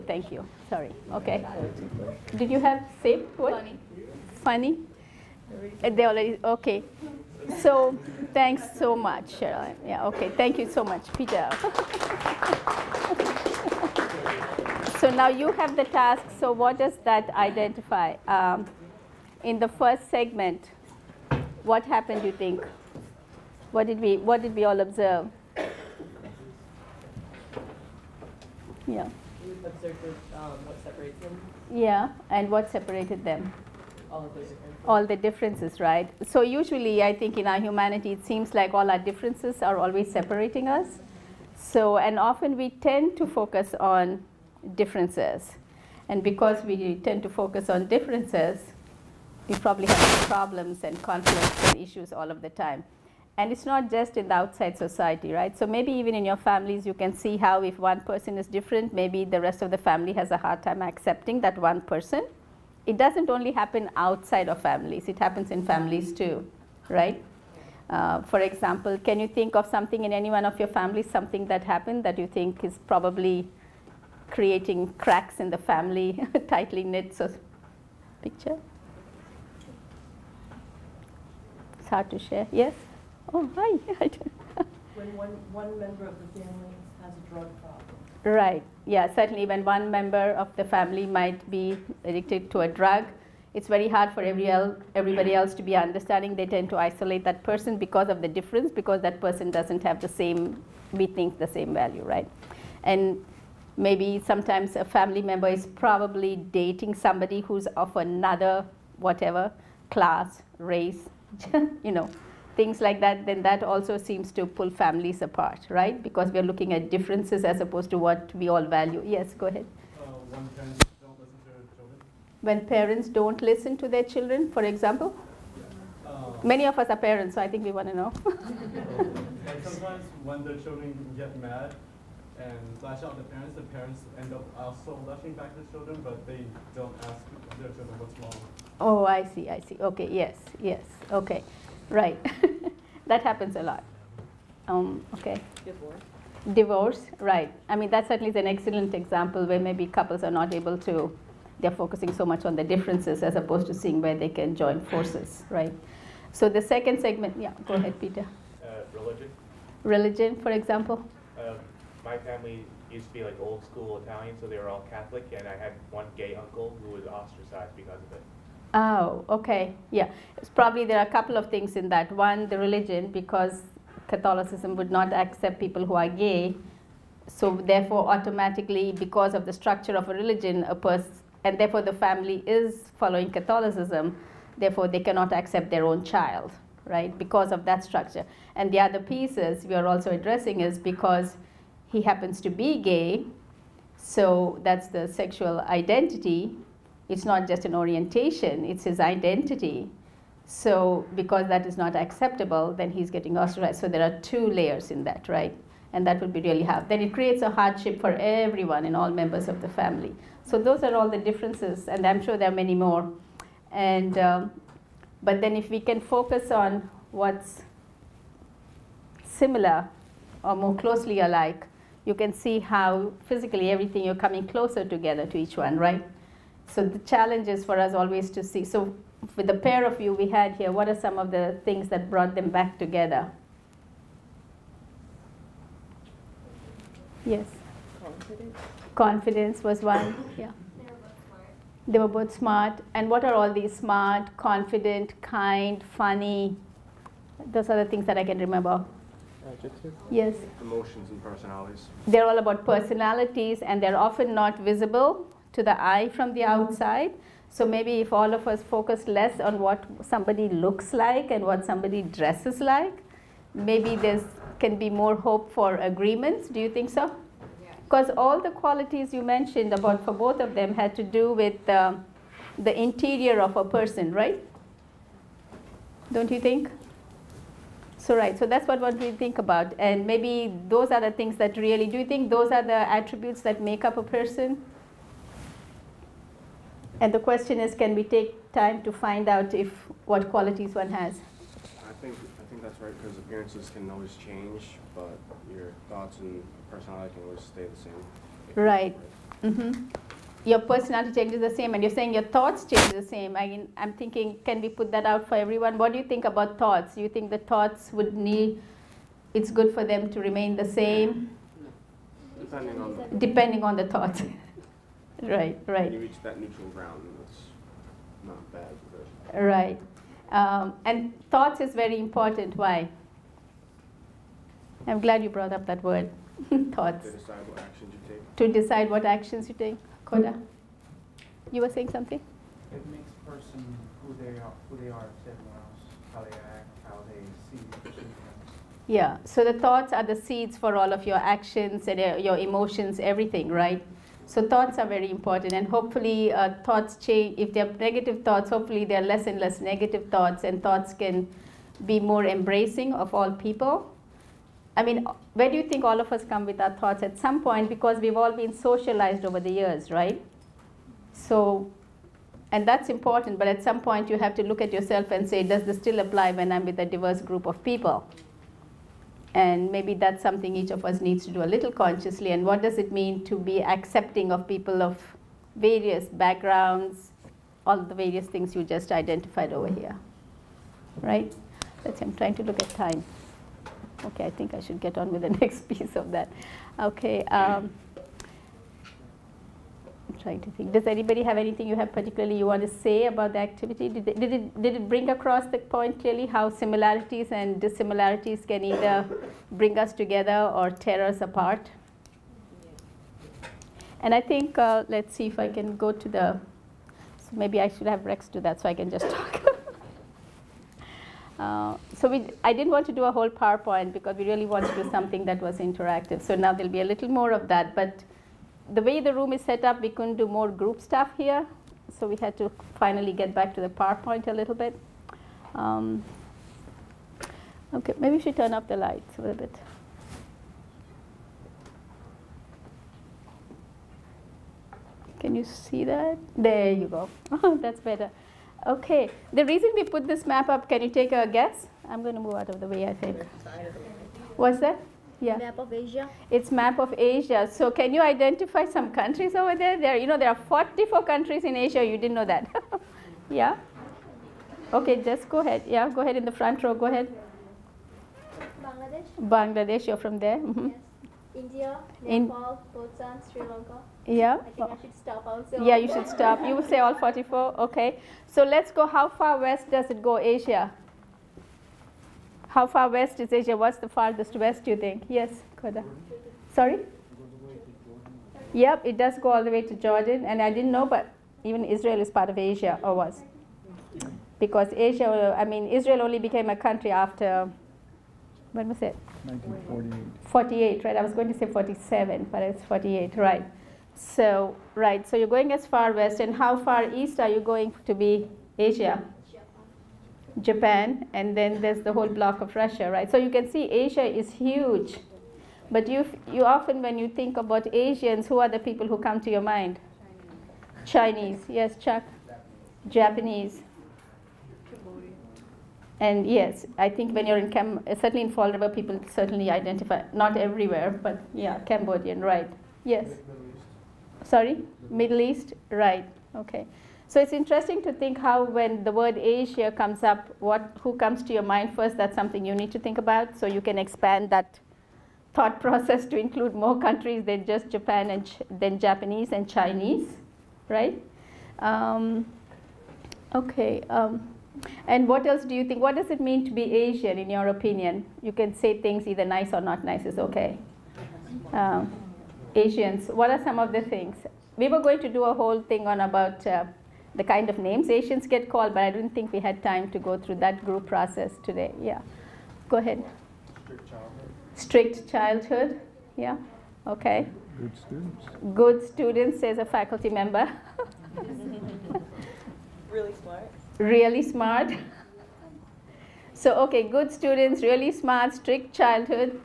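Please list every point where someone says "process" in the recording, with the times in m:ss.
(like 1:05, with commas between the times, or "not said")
8:55, 9:20.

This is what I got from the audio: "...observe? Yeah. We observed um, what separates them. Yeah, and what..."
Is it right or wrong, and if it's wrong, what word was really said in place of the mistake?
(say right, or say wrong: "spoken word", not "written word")
right.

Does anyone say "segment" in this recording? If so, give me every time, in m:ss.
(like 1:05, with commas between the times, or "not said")
0:20, 2:36.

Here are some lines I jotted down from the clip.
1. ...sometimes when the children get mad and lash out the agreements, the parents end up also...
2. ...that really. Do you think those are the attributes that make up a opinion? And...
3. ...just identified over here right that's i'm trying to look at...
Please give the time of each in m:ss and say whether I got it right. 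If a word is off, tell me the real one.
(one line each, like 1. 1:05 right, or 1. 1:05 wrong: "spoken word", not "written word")
1. 2:09 wrong: "parents", not "agreements"
2. 4:41 wrong: "person", not "opinion"
3. 6:18 right.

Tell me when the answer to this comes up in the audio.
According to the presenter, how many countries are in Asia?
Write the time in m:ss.
7:30.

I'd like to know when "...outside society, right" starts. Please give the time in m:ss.
0:54.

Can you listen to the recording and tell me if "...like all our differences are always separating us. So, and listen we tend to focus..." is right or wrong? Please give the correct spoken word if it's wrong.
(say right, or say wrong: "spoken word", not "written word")
wrong: "often", not "listen".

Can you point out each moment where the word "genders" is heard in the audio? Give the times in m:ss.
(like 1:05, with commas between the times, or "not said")
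not said.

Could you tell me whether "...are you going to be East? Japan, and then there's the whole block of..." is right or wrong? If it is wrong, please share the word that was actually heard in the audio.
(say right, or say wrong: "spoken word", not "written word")
wrong: "Asia", not "East".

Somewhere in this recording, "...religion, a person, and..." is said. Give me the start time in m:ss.
3:00.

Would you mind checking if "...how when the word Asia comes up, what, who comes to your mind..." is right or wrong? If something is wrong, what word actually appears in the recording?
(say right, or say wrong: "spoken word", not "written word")
right.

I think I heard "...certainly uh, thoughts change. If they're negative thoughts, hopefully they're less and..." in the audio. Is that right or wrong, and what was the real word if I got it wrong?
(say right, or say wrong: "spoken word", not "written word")
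wrong: "hopefully", not "certainly".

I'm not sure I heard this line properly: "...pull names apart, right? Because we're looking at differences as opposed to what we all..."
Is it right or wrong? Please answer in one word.
wrong.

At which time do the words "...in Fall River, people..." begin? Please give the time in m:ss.
8:38.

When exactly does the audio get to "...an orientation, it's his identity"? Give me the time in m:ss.
3:17.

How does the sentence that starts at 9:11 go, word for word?
Um, Asians, what are some of the things?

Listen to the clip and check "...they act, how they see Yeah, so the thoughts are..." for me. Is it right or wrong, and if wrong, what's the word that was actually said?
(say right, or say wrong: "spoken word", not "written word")
right.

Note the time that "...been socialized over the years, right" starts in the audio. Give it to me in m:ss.
5:58.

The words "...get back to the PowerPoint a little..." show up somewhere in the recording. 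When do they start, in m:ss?
7:03.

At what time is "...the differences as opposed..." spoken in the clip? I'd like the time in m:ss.
2:32.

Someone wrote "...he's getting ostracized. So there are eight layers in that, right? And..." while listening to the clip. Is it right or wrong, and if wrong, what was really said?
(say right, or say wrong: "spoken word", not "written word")
wrong: "two", not "eight".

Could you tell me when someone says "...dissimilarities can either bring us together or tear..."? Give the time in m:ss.
6:37.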